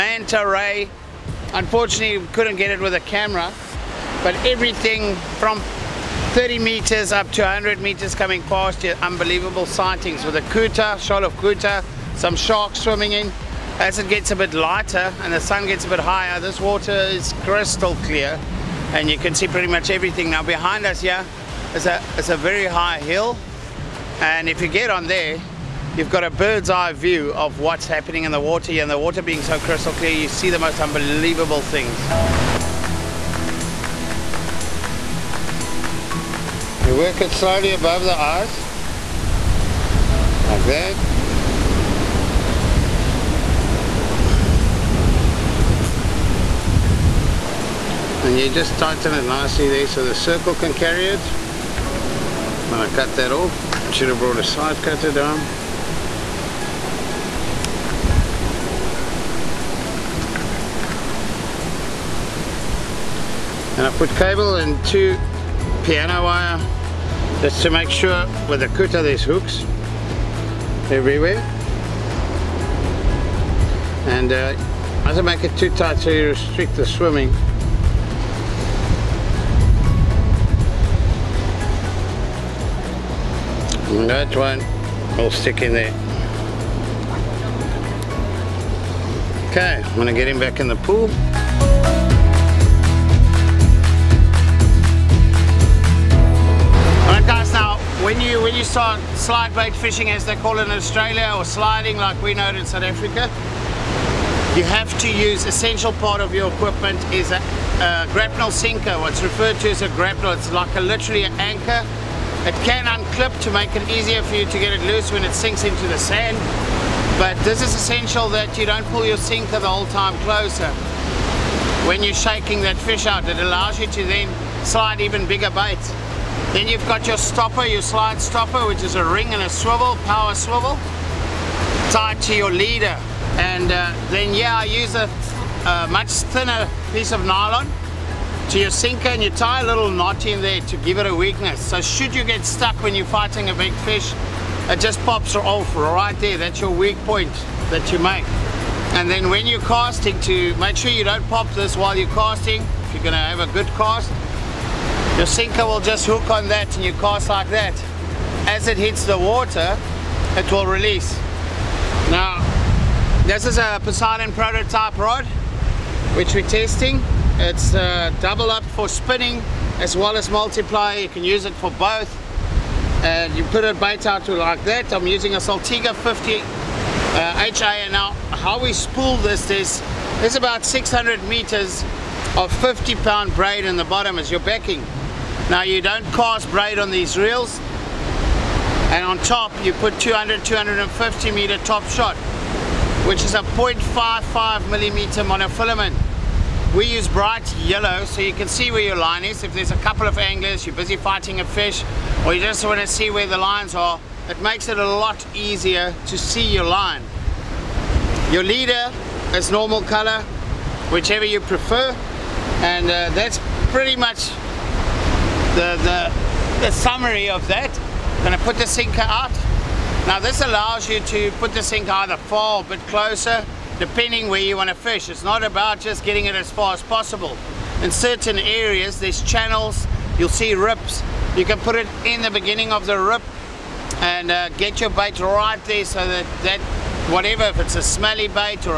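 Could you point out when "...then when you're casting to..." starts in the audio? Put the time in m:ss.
2:29.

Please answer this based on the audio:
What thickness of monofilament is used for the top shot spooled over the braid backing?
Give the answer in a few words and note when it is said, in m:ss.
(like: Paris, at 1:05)
0.55 millimeter, at 3:13.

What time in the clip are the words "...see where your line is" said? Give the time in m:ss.
3:18.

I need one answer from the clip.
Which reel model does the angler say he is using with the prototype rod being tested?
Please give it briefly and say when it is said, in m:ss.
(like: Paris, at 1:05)
Saltiga 50, at 2:55.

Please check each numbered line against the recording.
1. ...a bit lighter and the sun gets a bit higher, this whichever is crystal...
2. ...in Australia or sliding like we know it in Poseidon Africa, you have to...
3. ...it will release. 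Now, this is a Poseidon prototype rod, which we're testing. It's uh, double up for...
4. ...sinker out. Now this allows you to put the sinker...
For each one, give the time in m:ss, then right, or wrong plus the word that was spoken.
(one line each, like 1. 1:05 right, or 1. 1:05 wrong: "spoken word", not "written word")
1. 0:14 wrong: "water", not "whichever"
2. 1:40 wrong: "South", not "Poseidon"
3. 2:40 right
4. 3:38 right.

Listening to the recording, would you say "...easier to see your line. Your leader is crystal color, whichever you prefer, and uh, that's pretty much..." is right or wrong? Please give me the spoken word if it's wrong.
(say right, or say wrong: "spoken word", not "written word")
wrong: "normal", not "crystal".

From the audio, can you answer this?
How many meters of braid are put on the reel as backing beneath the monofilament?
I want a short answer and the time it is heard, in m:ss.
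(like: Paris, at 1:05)
600 meters, at 3:00.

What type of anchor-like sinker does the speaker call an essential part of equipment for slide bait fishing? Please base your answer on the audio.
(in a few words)
grapnel sinker.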